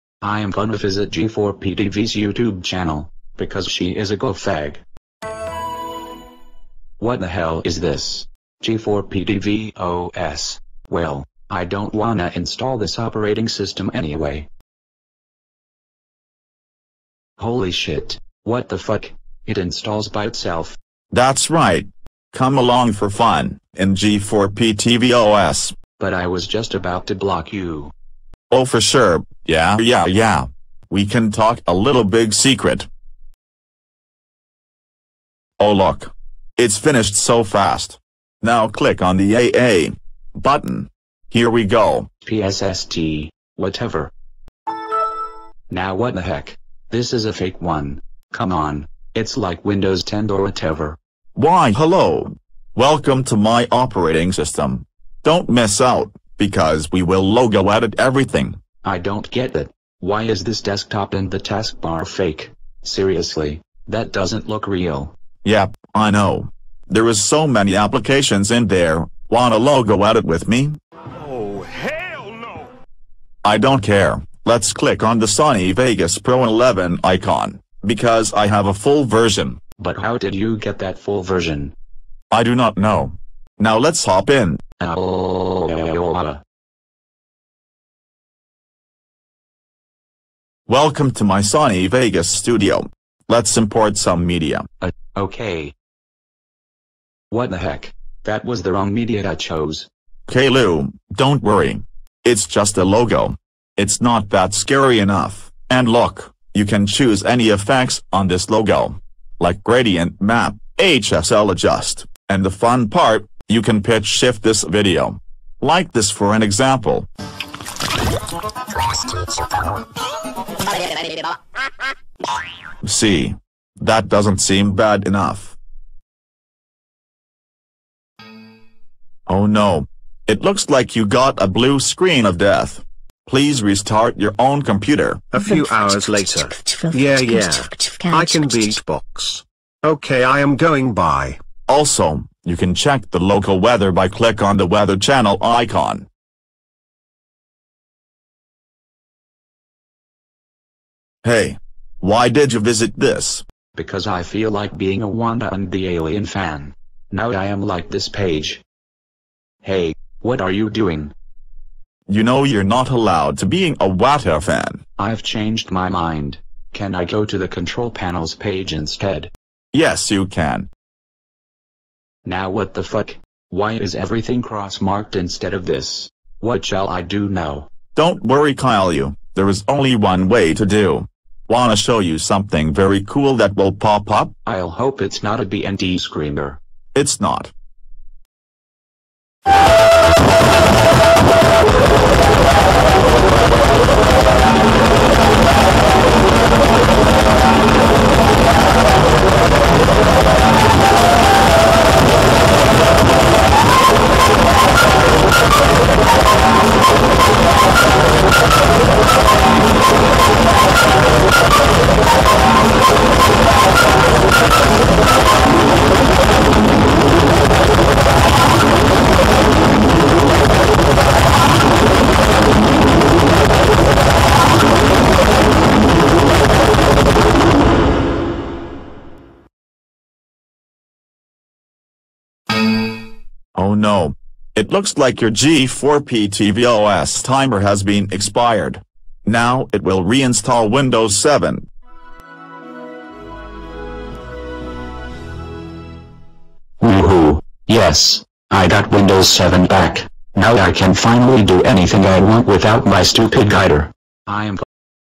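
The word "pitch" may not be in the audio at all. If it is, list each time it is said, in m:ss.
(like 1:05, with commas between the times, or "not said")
1:53.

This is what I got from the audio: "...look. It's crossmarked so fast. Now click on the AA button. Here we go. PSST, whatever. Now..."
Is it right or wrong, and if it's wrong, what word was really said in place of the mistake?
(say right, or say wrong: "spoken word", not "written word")
wrong: "finished", not "crossmarked".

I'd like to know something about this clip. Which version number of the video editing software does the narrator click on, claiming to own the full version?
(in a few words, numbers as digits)
11.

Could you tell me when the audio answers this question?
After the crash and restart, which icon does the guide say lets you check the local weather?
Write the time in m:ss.
2:24.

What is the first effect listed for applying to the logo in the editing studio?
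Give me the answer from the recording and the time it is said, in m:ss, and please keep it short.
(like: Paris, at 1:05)
Gradient map, at 1:49.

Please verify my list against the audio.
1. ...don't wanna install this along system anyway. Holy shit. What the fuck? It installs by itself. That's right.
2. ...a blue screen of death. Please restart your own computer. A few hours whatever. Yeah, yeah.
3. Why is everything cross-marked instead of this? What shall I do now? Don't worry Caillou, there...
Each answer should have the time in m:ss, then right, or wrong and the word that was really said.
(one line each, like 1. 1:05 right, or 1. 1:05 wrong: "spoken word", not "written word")
1. 0:11 wrong: "operating", not "along"
2. 2:11 wrong: "later", not "whatever"
3. 2:53 right.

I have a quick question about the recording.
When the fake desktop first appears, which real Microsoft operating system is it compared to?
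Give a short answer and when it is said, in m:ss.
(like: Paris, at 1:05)
Windows 10, at 0:49.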